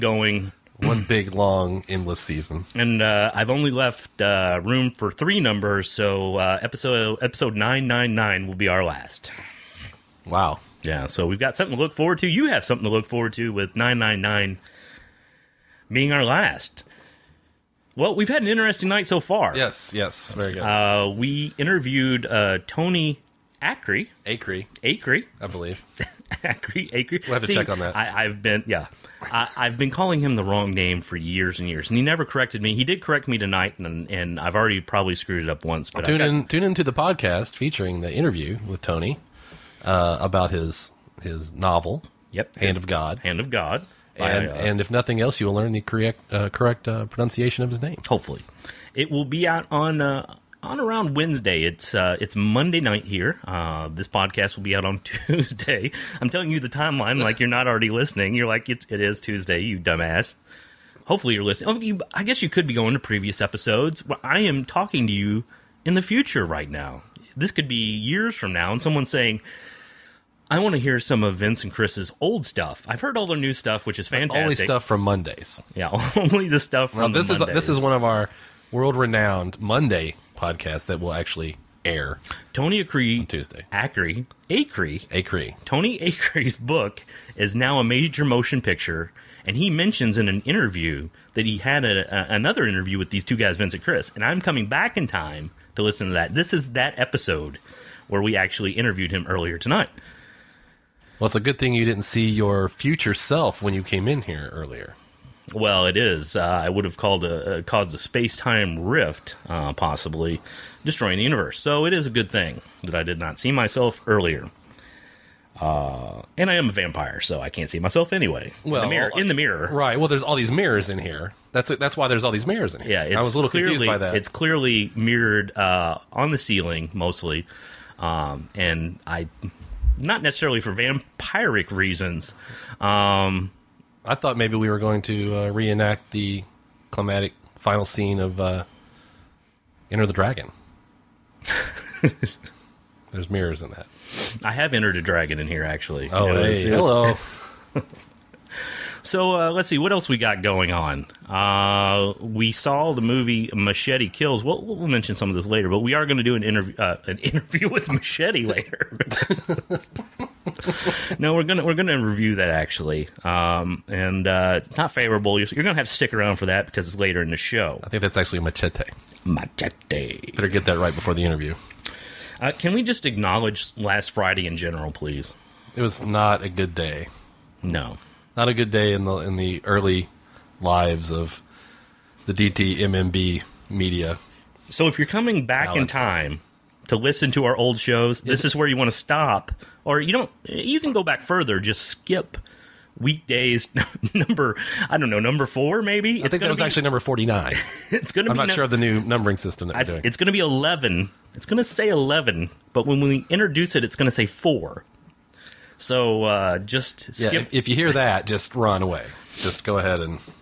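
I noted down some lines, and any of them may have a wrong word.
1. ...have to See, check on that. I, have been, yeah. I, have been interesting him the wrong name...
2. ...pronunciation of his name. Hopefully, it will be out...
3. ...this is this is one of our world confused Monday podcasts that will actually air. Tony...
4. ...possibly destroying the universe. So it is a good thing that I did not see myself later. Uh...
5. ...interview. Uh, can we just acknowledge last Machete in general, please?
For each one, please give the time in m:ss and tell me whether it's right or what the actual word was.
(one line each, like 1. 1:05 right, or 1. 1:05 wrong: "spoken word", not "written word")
1. 0:27 wrong: "calling", not "interesting"
2. 0:47 right
3. 1:17 wrong: "renowned", not "confused"
4. 1:49 wrong: "earlier", not "later"
5. 2:51 wrong: "Friday", not "Machete".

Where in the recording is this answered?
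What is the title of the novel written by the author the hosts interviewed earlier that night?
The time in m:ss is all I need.
0:43.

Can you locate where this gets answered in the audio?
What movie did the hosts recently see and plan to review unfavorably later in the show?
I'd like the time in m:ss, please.
2:33.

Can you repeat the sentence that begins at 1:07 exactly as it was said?
This could be years from now, and someone saying, I want to hear some of Vince and Chris's old stuff.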